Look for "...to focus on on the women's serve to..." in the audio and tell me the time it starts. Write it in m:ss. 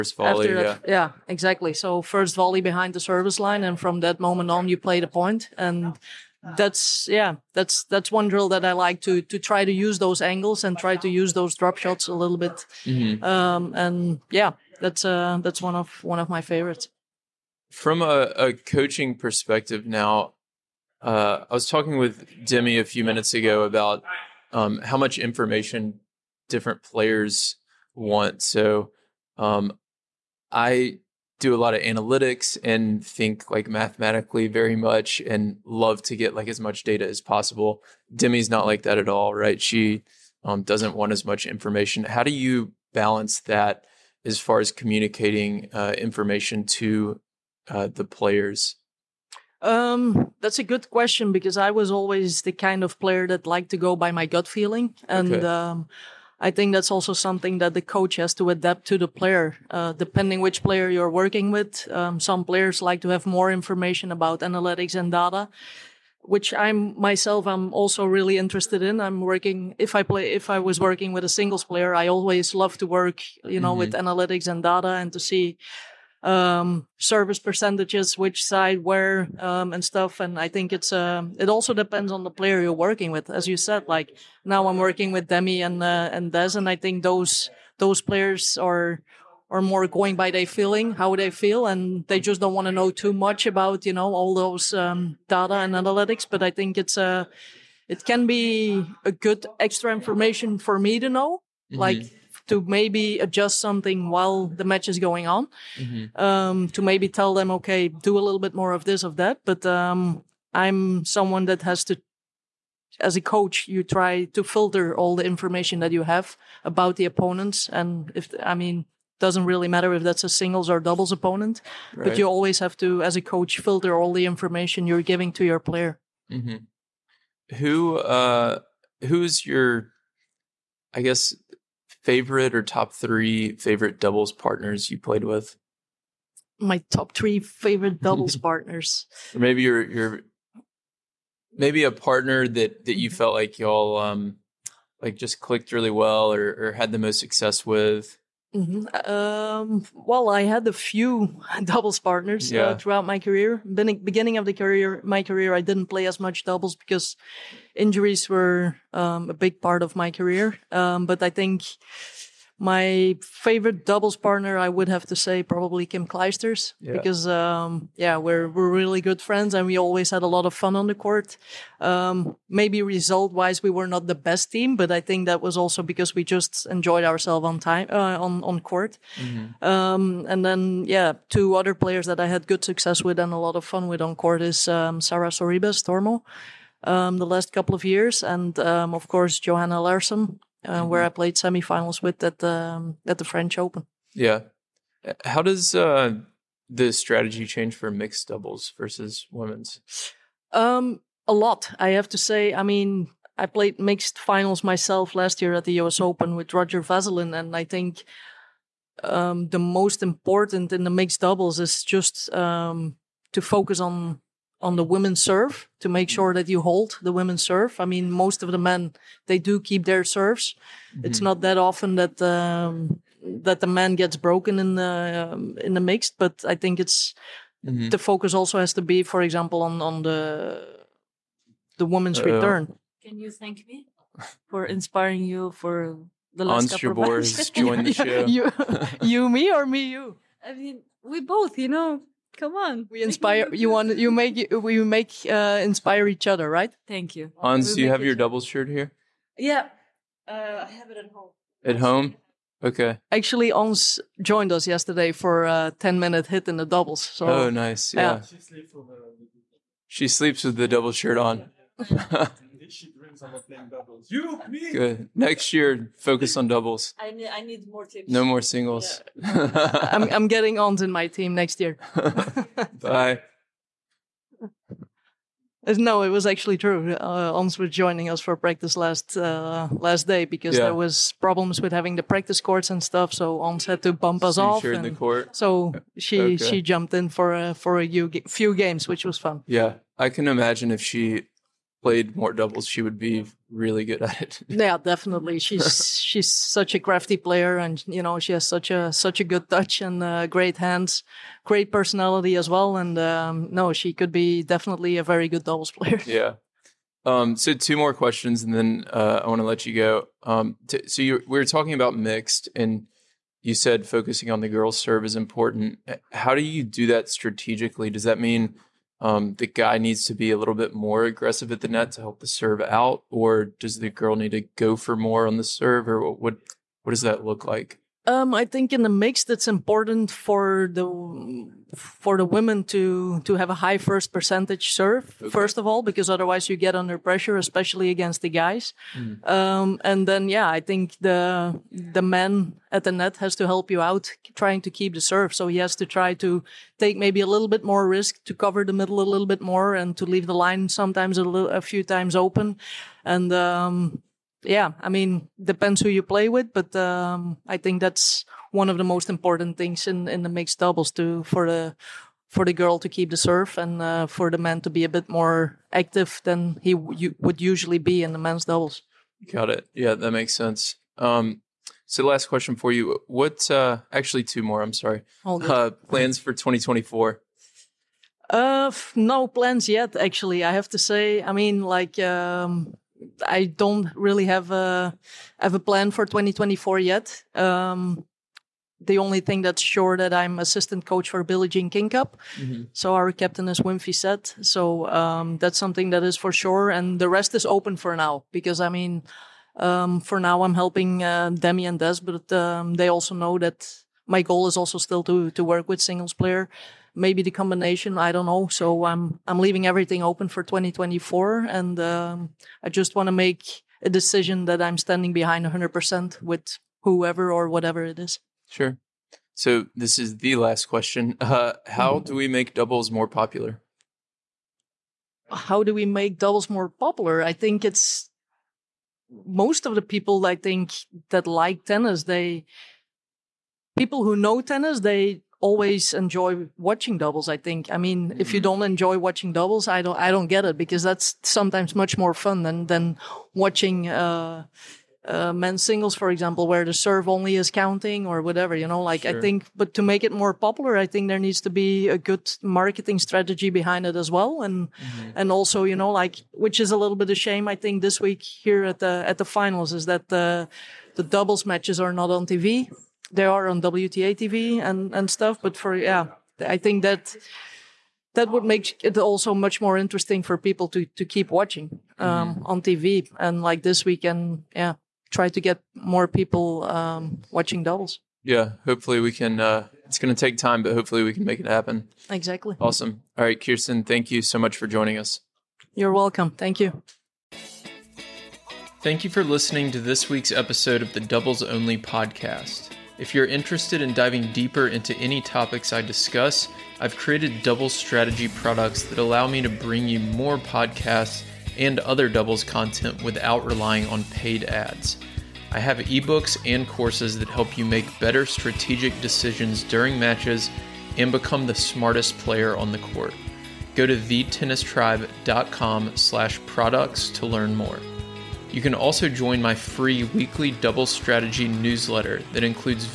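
3:33.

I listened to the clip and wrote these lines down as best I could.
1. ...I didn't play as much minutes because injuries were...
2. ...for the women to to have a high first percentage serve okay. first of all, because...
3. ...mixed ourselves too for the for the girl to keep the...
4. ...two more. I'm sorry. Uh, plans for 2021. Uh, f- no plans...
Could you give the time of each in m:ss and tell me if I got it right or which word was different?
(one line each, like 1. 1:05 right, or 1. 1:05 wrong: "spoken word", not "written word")
1. 2:35 wrong: "doubles", not "minutes"
2. 5:31 right
3. 6:00 wrong: "doubles", not "ourselves"
4. 6:14 wrong: "2024", not "2021".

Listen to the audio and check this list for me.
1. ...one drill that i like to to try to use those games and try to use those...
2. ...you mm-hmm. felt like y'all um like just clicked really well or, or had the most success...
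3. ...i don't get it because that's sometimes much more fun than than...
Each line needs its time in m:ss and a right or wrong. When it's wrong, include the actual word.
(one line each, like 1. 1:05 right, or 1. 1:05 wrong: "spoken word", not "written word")
1. 0:08 wrong: "angles", not "games"
2. 2:22 right
3. 7:19 right.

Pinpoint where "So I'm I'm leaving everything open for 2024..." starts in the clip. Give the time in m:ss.
6:48.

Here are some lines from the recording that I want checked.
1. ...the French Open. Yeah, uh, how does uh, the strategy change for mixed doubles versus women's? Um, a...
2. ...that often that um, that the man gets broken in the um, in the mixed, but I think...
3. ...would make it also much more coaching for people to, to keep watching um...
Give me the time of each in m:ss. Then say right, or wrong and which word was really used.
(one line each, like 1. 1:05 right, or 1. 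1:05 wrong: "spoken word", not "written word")
1. 3:13 right
2. 3:41 right
3. 7:48 wrong: "interesting", not "coaching".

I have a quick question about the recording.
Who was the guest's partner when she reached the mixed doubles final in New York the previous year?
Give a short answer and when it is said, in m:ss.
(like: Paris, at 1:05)
Roger-Vasselin, at 3:26.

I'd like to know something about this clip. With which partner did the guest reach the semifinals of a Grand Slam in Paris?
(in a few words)
Johanna Larsson.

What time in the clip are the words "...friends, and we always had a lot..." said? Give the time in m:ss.
2:49.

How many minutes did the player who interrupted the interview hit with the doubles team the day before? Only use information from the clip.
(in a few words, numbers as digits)
10.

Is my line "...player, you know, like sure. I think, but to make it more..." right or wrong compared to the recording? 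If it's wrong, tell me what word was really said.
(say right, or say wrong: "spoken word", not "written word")
wrong: "whatever", not "player".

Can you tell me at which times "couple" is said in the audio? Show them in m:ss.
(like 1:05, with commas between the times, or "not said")
3:07, 3:56.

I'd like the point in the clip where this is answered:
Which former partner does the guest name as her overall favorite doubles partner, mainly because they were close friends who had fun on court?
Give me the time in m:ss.
2:45.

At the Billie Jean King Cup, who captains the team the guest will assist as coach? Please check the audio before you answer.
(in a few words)
Wim Fissette.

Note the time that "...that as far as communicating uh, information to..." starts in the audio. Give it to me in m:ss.
0:43.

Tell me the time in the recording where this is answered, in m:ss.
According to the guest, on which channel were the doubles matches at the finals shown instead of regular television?
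7:43.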